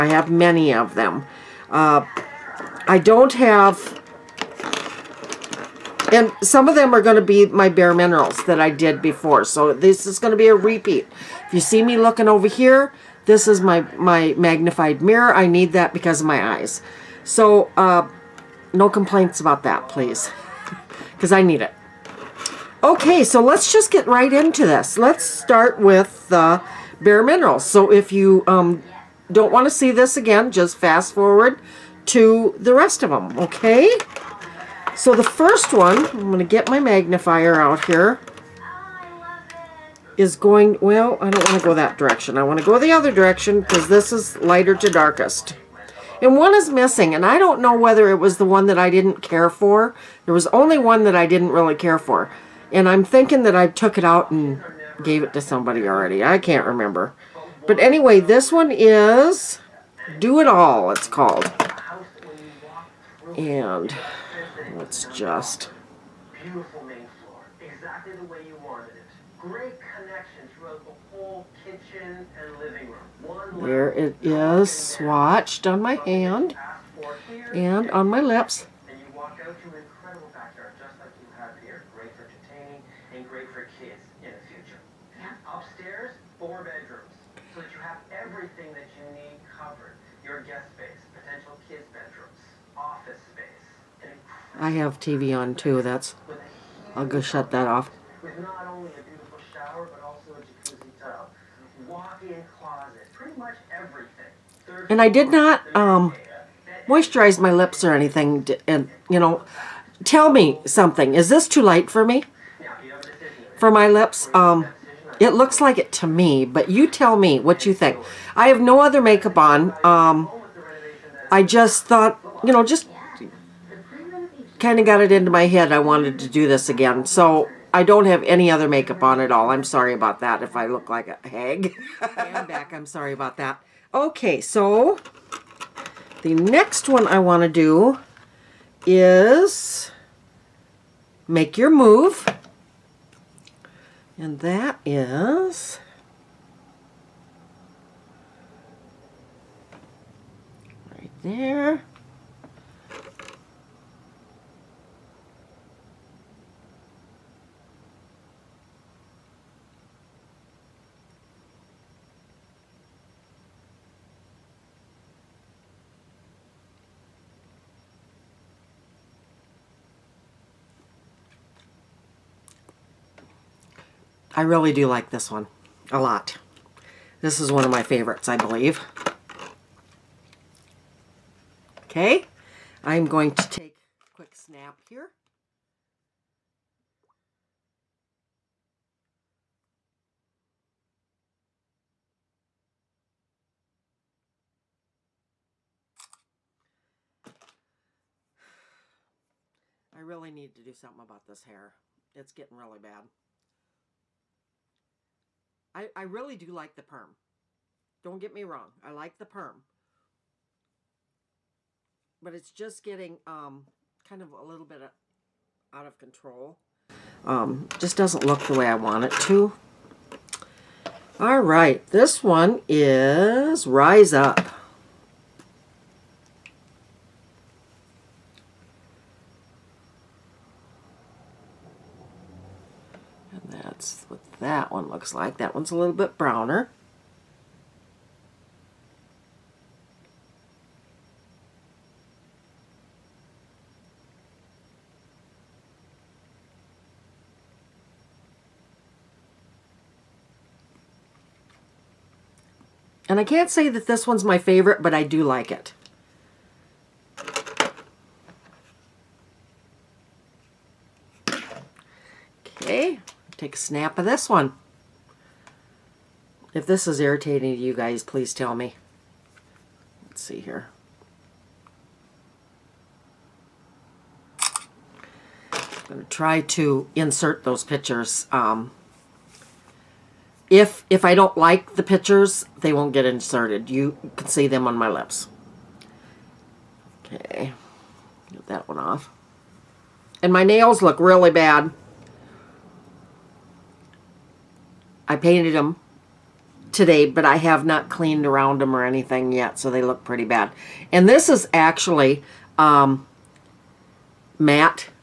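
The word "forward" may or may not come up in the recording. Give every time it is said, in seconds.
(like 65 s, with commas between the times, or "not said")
31 s.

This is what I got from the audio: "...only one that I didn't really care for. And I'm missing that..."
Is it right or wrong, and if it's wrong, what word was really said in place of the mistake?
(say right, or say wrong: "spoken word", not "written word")
wrong: "thinking", not "missing".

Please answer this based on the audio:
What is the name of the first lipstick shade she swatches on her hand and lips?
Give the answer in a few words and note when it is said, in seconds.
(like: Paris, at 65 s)
Do It All, at 60 s.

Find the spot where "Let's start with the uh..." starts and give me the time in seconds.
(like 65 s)
24 s.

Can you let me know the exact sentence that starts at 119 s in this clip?
Um, I just thought, you know, just kind of got it into my head I wanted to do this again.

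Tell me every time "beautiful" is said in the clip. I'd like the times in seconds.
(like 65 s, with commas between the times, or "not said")
66 s, 99 s.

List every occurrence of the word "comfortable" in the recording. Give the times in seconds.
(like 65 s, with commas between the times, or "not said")
not said.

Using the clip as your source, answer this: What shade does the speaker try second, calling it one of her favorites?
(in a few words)
Make Your Move.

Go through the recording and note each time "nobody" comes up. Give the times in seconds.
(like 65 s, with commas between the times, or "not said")
not said.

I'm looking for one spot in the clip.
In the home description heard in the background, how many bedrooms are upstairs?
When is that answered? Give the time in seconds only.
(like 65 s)
86 s.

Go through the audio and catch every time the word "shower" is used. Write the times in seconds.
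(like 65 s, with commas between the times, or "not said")
99 s.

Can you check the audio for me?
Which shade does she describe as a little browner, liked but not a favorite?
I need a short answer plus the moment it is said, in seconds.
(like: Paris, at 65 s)
Rise Up, at 223 s.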